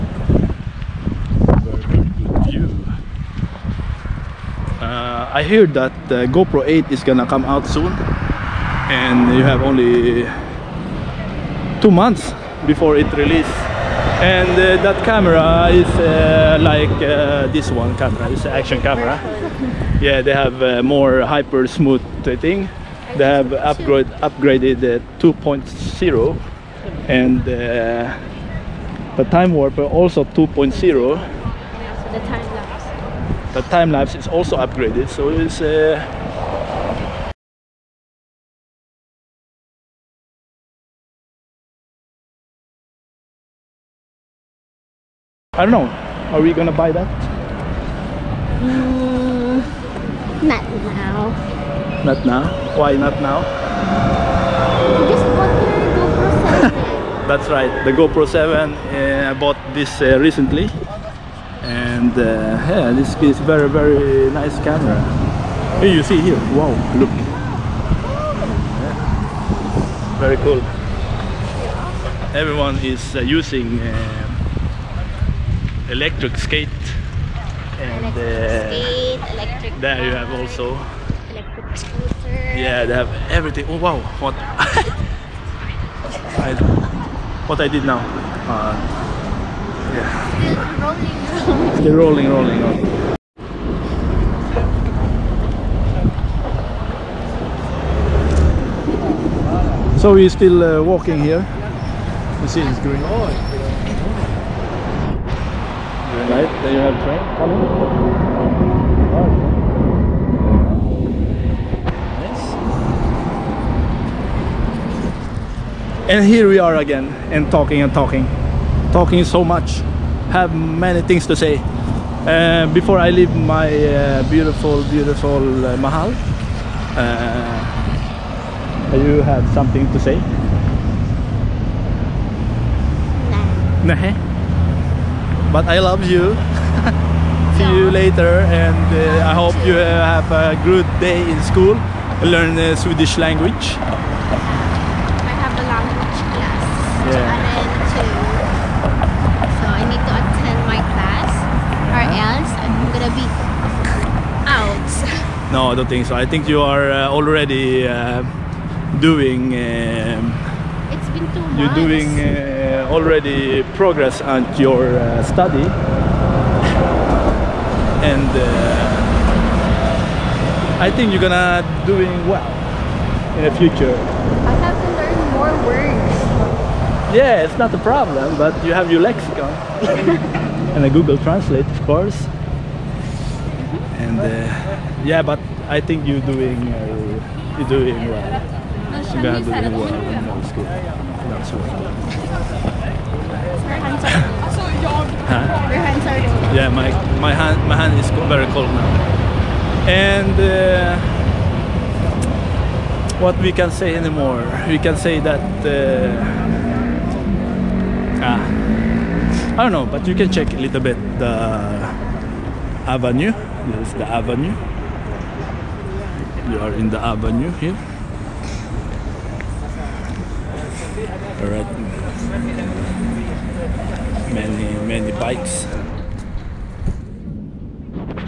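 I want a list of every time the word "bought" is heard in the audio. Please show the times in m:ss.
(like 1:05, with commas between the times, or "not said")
0:55, 0:59.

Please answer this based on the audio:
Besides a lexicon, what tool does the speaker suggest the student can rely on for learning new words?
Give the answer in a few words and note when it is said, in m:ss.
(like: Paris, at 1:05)
Google Translate, at 3:00.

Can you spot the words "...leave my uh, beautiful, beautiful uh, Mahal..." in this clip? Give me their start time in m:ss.
2:03.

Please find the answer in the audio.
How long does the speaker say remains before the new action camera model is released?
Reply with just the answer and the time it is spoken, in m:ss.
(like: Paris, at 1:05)
2 months, at 0:11.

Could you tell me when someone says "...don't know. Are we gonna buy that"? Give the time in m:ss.
0:45.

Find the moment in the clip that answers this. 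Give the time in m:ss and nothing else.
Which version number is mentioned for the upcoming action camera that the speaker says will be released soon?
0:06.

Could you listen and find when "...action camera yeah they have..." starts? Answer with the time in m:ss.
0:18.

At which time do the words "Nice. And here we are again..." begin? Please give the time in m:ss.
1:52.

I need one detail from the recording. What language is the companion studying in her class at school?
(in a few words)
Swedish.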